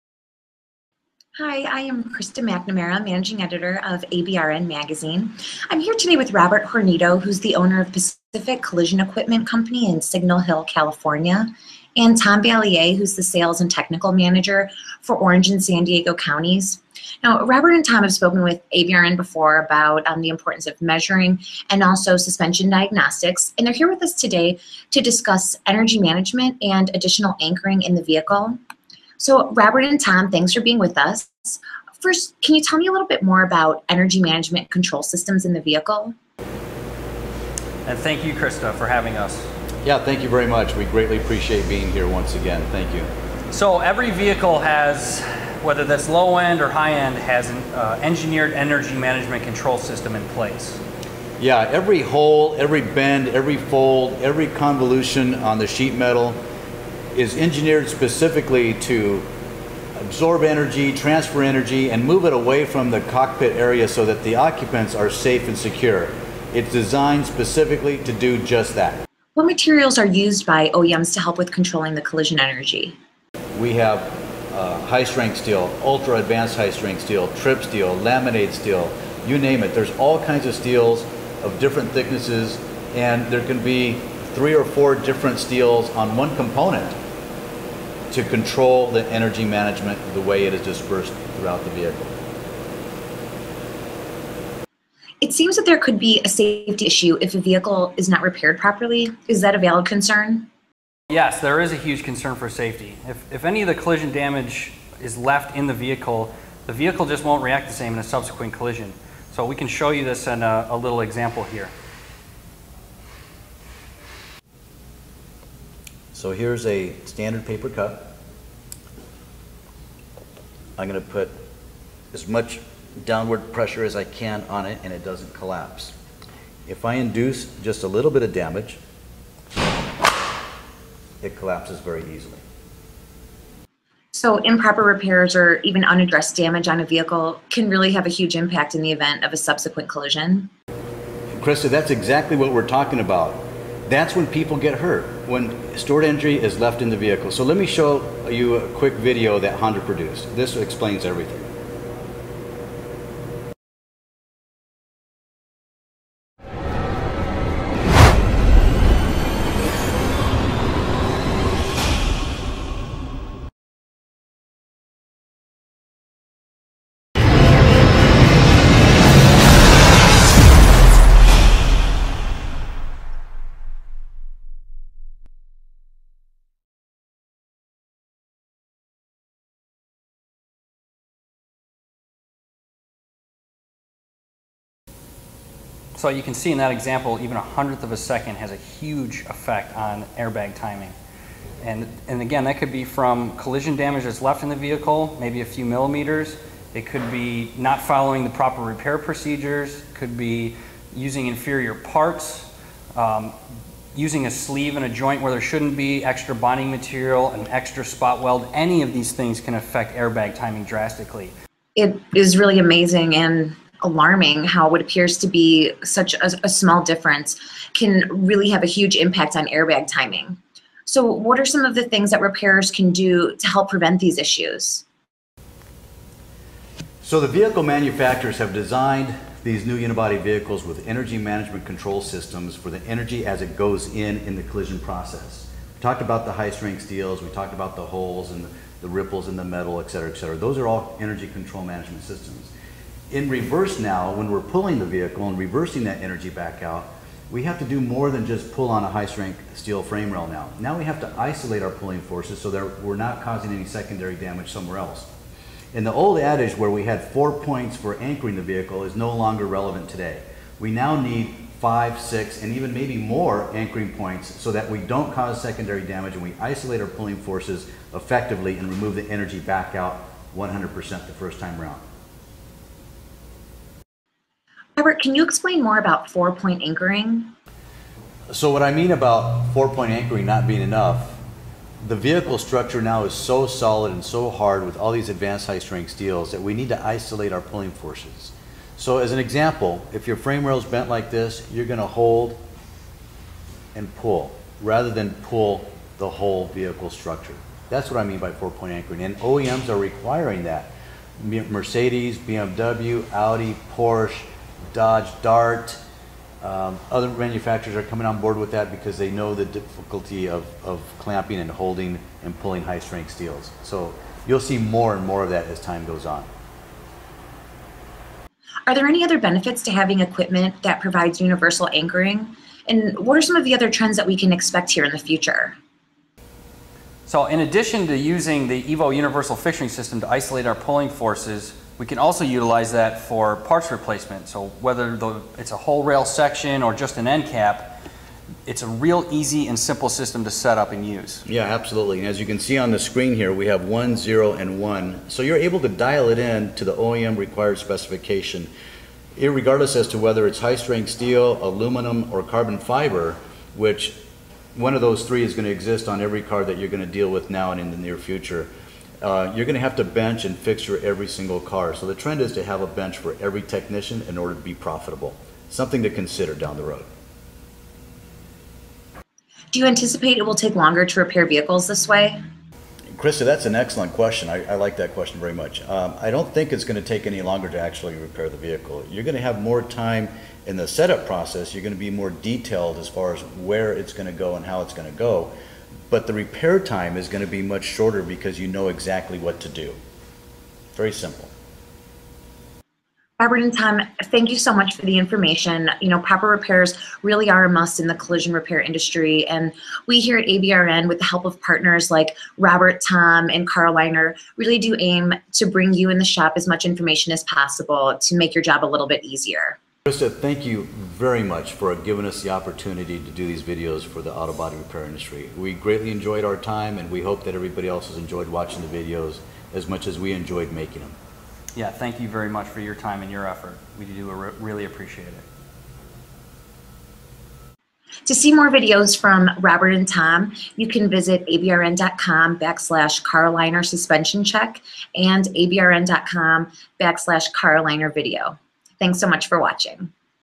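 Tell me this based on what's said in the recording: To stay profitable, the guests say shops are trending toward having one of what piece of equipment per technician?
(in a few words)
a bench.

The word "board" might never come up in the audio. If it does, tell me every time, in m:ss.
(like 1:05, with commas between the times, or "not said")
5:08.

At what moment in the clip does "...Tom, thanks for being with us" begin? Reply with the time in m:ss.
0:30.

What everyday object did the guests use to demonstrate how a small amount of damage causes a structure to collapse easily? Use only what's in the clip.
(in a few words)
paper cup.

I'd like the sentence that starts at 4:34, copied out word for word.
Robert, can you explain more about four point anchoring?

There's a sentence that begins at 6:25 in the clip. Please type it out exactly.
But the repair time is going to be much shorter because you know exactly what to do.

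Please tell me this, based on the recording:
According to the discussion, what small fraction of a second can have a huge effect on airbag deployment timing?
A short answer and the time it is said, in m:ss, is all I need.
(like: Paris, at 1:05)
a hundredth, at 3:07.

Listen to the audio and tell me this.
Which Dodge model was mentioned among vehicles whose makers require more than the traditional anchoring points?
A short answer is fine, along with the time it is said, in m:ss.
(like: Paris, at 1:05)
Dart, at 5:04.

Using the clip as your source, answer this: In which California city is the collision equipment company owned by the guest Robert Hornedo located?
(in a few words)
Signal Hill.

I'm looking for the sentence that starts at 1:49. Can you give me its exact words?
So we can show you this in a, a little example here.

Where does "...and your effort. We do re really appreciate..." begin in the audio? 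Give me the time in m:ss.
7:03.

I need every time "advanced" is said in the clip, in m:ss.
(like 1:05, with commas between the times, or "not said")
1:16, 4:45.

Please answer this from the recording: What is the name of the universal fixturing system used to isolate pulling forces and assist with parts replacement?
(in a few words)
EVO.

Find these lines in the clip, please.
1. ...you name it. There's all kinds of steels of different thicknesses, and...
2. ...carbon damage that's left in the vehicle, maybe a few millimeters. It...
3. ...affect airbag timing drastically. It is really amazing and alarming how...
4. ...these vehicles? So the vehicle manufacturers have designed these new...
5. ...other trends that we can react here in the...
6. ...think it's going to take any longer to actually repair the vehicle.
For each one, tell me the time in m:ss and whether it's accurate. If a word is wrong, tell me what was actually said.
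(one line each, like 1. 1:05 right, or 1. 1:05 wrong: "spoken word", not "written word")
1. 1:19 right
2. 3:13 wrong: "collision", not "carbon"
3. 3:29 right
4. 3:43 wrong: "issues", not "vehicles"
5. 5:23 wrong: "expect", not "react"
6. 6:16 right.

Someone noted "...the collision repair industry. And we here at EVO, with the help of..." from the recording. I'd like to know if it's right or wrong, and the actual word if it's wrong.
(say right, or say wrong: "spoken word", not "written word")
wrong: "ABRN", not "EVO".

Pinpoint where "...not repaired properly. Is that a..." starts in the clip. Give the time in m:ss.
1:38.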